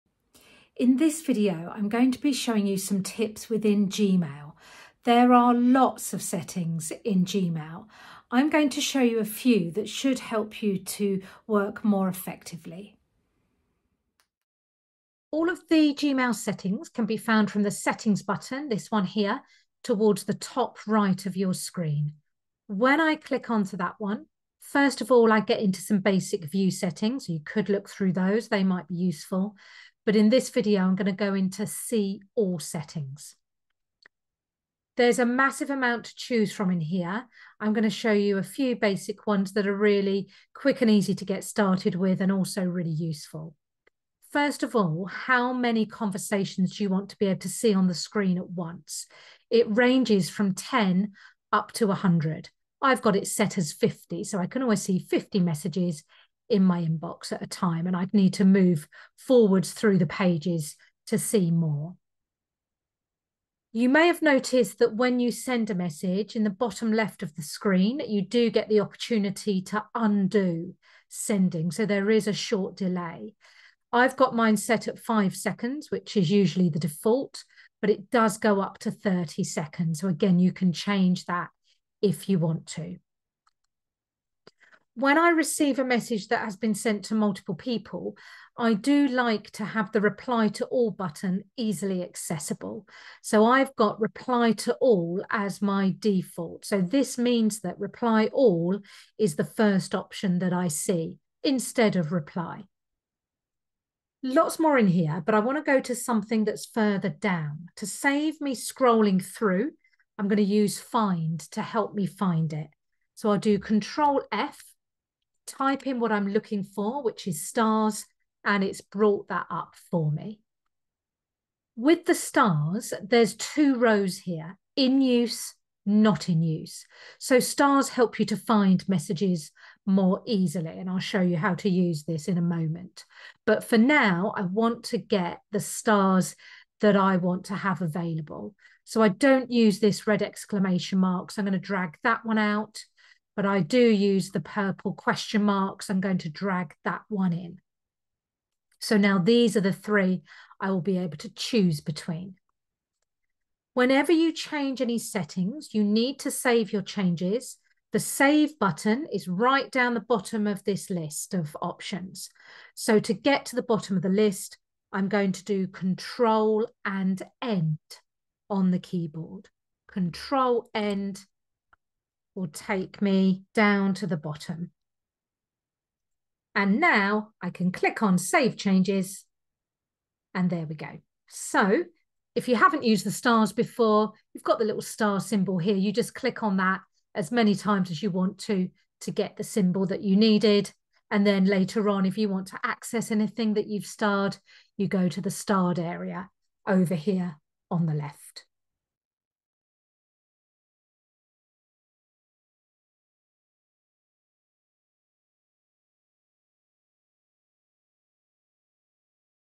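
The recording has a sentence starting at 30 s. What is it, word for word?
But in this video, I'm going to go into see all settings.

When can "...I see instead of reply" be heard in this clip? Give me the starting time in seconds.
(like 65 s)
100 s.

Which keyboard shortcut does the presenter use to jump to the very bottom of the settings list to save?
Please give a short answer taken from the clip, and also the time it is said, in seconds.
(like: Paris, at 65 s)
Control End, at 165 s.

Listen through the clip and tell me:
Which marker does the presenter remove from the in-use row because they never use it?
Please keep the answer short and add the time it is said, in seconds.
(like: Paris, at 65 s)
red exclamation mark, at 140 s.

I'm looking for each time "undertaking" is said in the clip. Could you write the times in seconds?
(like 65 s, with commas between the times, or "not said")
not said.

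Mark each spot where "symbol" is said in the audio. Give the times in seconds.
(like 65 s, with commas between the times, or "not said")
185 s, 189 s.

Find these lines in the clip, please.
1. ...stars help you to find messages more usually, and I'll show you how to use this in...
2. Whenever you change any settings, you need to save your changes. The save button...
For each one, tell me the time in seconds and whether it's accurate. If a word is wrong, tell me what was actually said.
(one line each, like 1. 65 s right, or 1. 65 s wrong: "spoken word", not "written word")
1. 127 s wrong: "easily", not "usually"
2. 153 s right.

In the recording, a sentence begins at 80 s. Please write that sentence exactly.
So again, you can change that if you want to.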